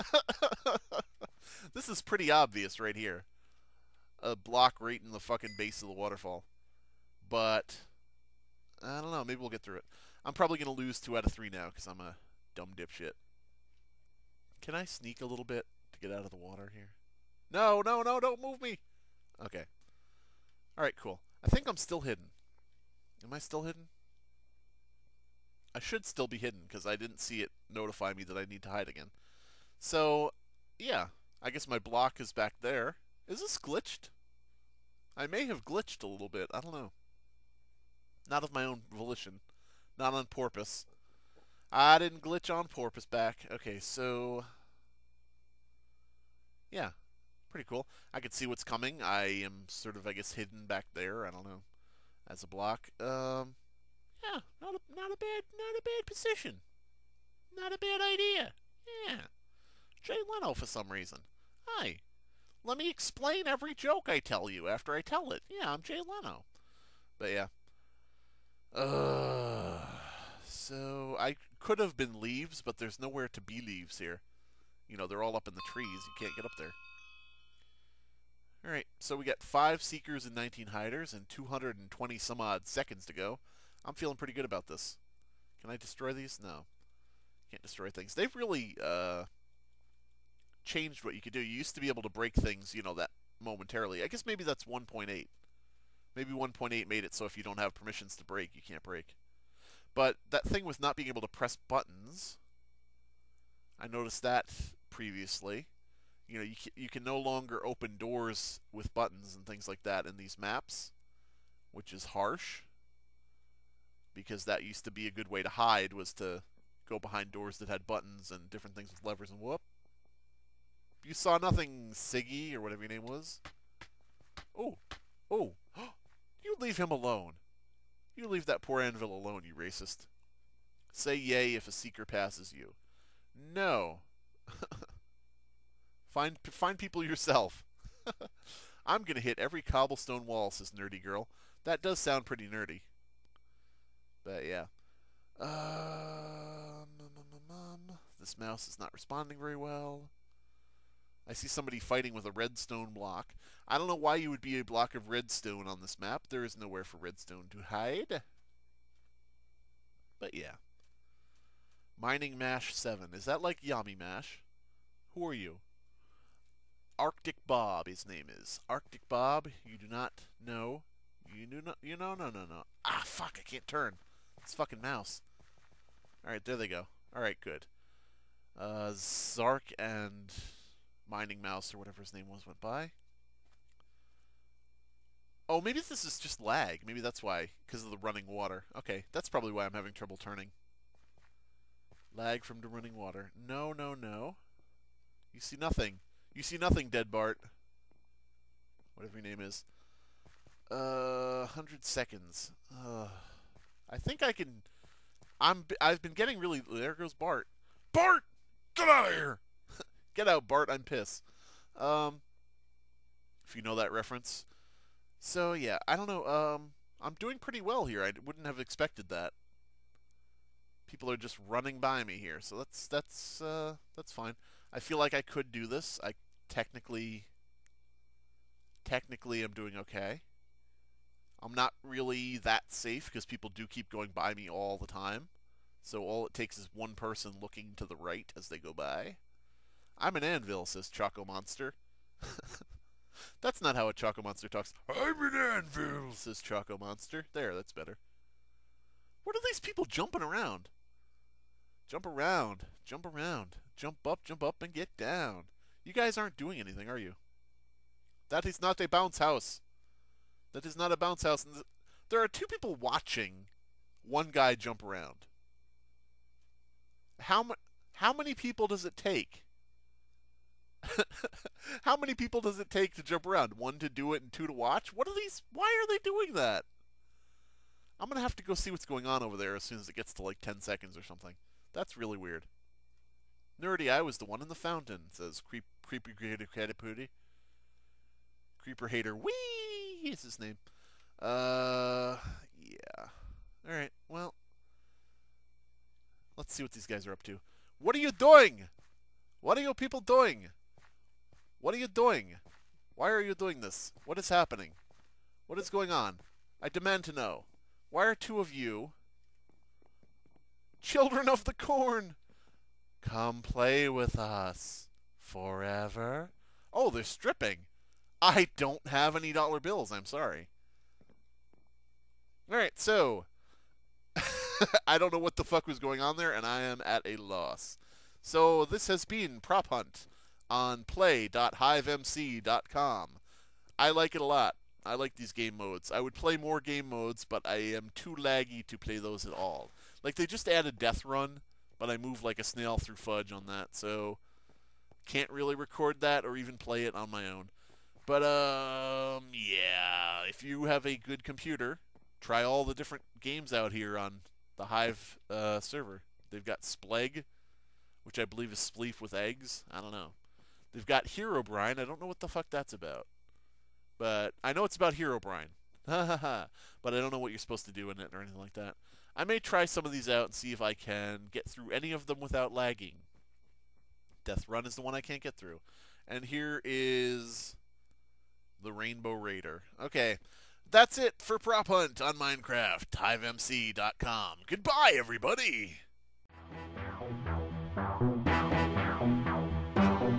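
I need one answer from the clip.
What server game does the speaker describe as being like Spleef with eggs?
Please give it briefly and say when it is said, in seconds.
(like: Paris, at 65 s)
Splegg, at 356 s.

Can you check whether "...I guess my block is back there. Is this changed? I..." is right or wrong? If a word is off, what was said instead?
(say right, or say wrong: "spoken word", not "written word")
wrong: "glitched", not "changed".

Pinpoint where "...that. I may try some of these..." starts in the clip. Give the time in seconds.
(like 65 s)
368 s.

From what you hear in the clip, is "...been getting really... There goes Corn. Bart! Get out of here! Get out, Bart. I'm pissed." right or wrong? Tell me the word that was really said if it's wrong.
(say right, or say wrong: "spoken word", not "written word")
wrong: "Bart", not "Corn".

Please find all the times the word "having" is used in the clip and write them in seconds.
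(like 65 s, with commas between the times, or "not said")
189 s.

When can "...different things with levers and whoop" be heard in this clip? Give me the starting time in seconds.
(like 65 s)
118 s.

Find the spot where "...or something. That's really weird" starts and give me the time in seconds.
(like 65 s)
280 s.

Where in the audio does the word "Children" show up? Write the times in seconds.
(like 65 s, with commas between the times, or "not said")
310 s.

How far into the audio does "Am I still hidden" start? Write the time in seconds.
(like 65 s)
23 s.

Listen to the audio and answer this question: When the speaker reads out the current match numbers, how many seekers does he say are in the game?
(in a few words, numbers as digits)
5.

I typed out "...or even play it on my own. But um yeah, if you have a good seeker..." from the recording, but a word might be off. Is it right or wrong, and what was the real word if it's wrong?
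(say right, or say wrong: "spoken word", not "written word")
wrong: "computer", not "seeker".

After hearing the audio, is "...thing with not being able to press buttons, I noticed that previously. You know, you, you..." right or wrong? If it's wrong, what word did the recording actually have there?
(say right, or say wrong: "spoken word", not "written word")
right.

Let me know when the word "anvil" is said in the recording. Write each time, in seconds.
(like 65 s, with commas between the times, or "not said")
128 s, 240 s, 245 s.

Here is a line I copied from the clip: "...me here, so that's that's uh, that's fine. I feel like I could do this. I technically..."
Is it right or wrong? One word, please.
right.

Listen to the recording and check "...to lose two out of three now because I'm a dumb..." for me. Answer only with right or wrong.
right.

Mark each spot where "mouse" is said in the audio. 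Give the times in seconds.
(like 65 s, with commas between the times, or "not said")
148 s, 174 s, 181 s.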